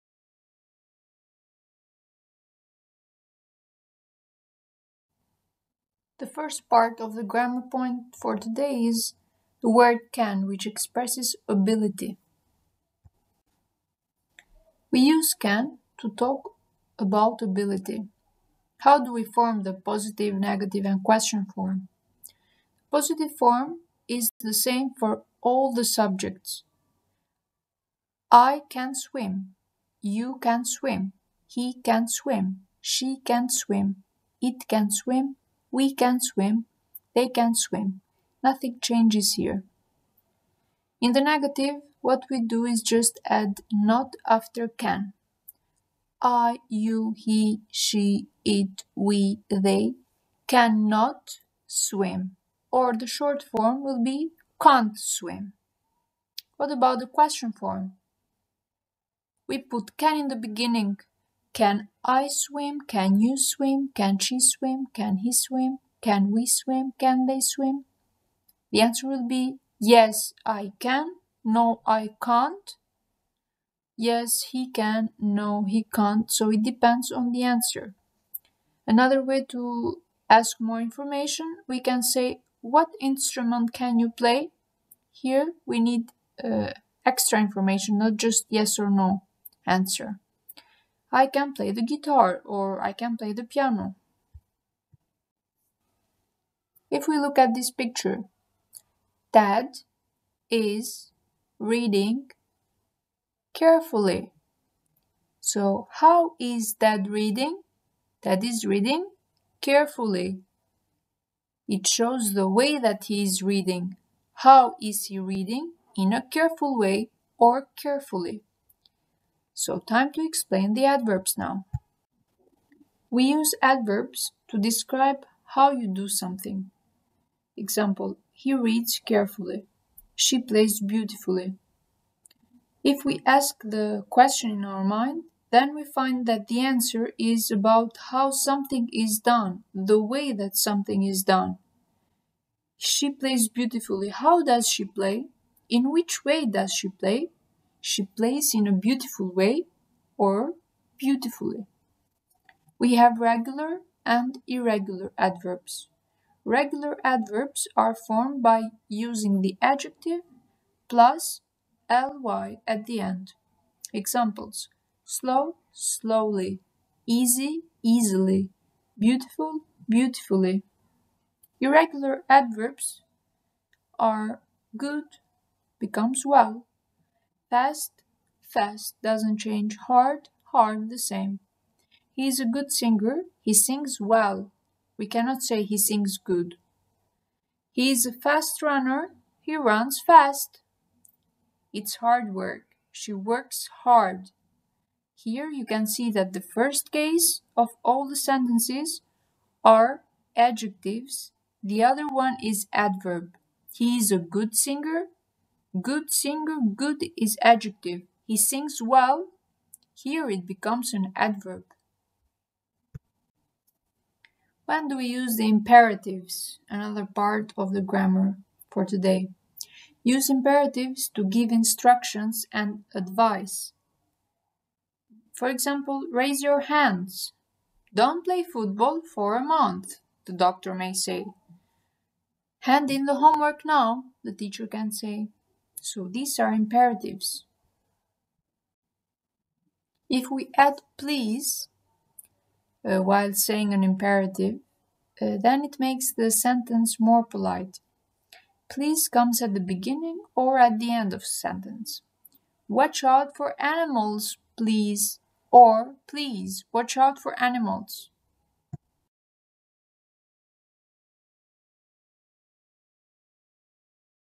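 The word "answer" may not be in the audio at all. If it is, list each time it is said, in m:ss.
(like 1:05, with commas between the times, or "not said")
1:08, 1:17, 1:29, 2:16.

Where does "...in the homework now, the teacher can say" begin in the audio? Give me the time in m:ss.
3:52.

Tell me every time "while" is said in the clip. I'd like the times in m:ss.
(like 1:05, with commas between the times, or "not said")
4:03.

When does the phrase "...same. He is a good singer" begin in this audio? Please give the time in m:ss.
3:00.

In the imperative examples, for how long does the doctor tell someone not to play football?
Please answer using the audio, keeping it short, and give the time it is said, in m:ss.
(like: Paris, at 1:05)
a month, at 3:49.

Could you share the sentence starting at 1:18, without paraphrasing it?
Another way to ask more information, we can say, What instrument can you play?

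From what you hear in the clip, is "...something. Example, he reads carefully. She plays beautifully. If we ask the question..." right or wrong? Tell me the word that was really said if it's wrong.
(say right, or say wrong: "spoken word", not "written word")
right.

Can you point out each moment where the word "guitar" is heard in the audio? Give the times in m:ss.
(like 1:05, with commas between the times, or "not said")
1:31.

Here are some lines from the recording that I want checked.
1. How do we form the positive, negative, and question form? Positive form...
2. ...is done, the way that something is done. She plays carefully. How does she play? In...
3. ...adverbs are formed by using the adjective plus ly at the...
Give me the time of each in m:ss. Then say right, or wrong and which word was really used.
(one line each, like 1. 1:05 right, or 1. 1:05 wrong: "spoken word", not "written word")
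1. 0:18 right
2. 2:18 wrong: "beautifully", not "carefully"
3. 2:37 right.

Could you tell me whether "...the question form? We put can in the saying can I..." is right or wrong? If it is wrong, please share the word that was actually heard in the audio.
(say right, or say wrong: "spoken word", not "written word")
wrong: "beginning", not "saying".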